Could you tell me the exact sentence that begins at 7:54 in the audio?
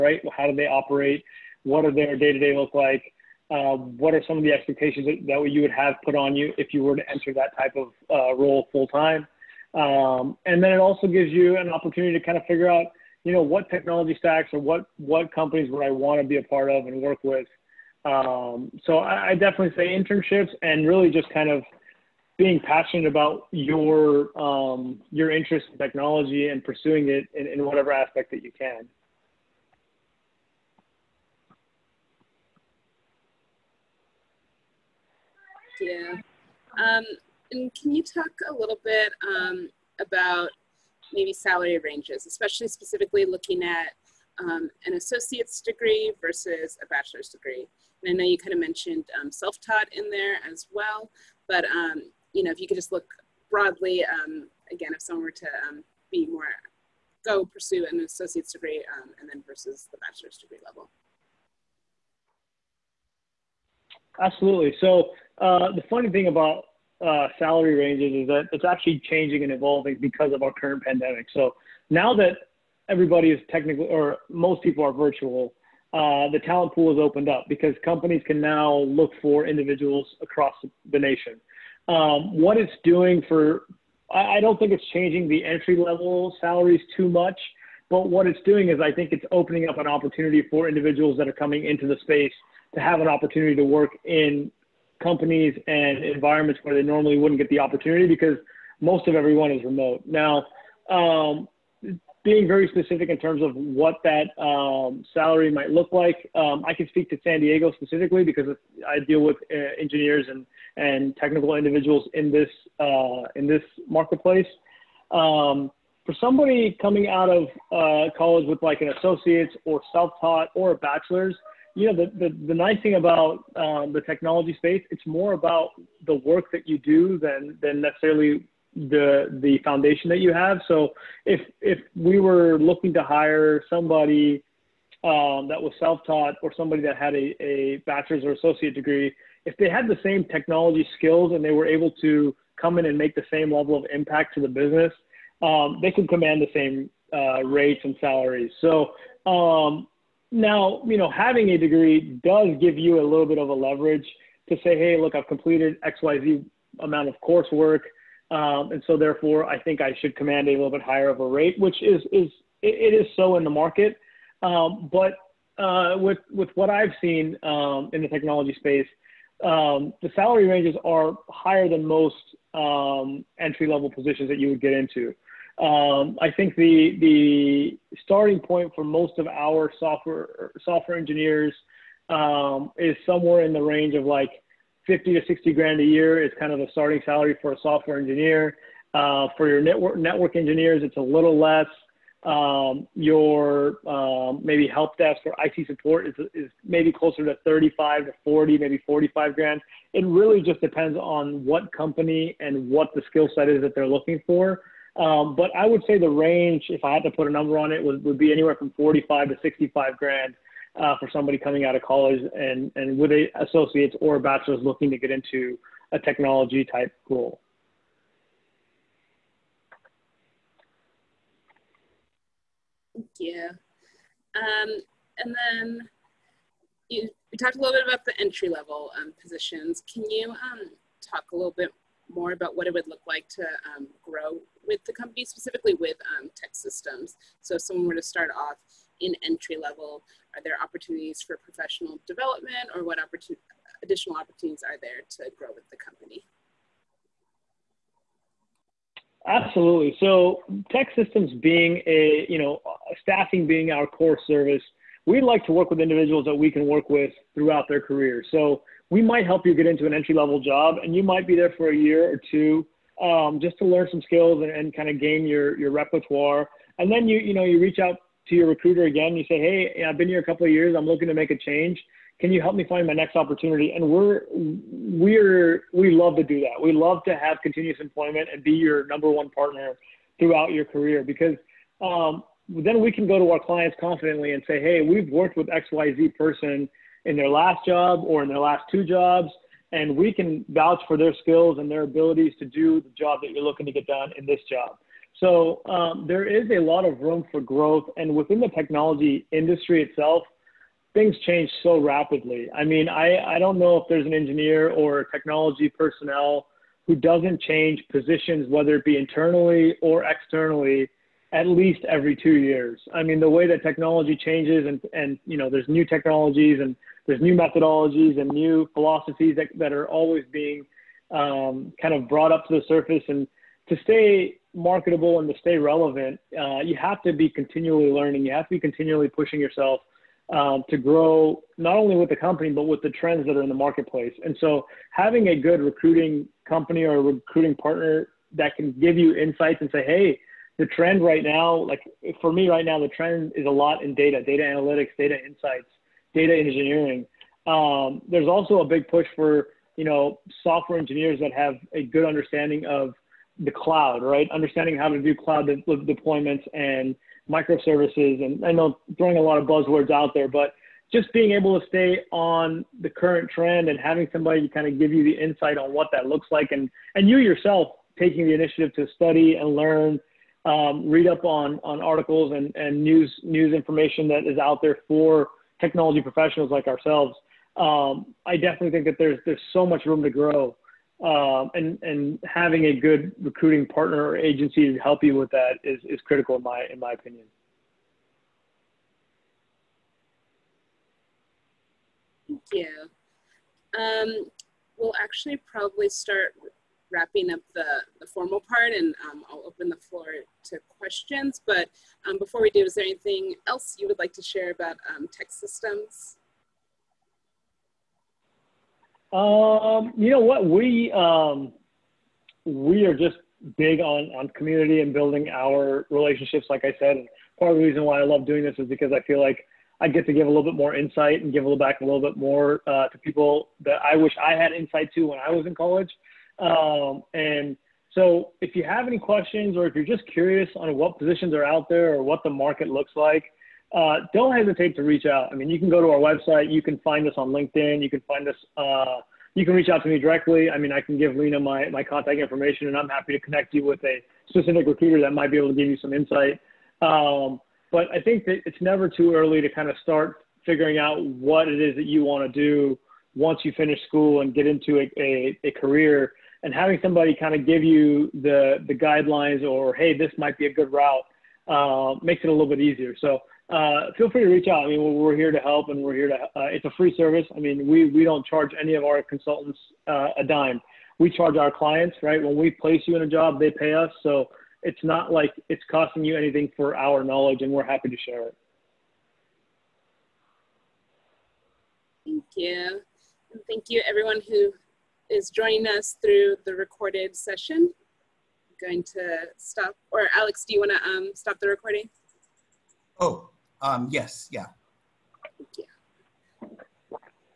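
So it's not like it's costing you anything for our knowledge, and we're happy to share it.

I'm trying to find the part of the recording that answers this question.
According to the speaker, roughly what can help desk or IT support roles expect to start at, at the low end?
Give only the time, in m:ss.
3:17.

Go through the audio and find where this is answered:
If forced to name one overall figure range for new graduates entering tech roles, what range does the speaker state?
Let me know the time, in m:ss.
3:28.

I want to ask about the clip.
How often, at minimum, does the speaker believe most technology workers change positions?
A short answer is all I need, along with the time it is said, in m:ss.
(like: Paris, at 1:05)
every two years, at 5:11.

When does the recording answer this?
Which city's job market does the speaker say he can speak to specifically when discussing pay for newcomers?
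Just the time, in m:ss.
1:47.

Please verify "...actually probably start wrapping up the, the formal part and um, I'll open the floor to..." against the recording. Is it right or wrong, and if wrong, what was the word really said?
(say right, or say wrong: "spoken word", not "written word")
right.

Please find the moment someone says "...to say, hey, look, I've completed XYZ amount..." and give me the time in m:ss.
2:34.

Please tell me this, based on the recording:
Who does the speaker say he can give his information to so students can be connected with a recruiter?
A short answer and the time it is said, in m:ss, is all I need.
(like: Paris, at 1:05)
Lena, at 7:21.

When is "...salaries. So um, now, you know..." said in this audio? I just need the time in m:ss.
2:28.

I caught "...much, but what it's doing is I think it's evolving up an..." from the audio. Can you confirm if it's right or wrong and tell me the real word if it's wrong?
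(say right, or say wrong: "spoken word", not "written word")
wrong: "opening", not "evolving".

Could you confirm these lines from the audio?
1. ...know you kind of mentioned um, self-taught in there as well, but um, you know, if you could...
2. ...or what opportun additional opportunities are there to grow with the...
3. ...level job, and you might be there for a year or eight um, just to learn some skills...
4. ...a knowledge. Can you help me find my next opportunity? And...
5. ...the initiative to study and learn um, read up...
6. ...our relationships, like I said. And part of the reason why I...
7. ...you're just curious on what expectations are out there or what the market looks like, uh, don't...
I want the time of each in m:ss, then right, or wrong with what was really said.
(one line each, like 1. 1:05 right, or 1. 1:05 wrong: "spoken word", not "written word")
1. 0:48 right
2. 4:02 right
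3. 4:20 wrong: "two", not "eight"
4. 4:31 wrong: "change", not "knowledge"
5. 6:08 right
6. 6:55 right
7. 7:09 wrong: "positions", not "expectations".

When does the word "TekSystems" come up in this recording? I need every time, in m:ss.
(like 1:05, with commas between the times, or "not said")
3:56, 4:10, 6:45.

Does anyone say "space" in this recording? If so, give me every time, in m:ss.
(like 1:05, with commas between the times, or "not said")
1:32, 2:04, 2:48.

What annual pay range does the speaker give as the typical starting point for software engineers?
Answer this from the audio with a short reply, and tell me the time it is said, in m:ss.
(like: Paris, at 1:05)
50 to 60 grand, at 3:04.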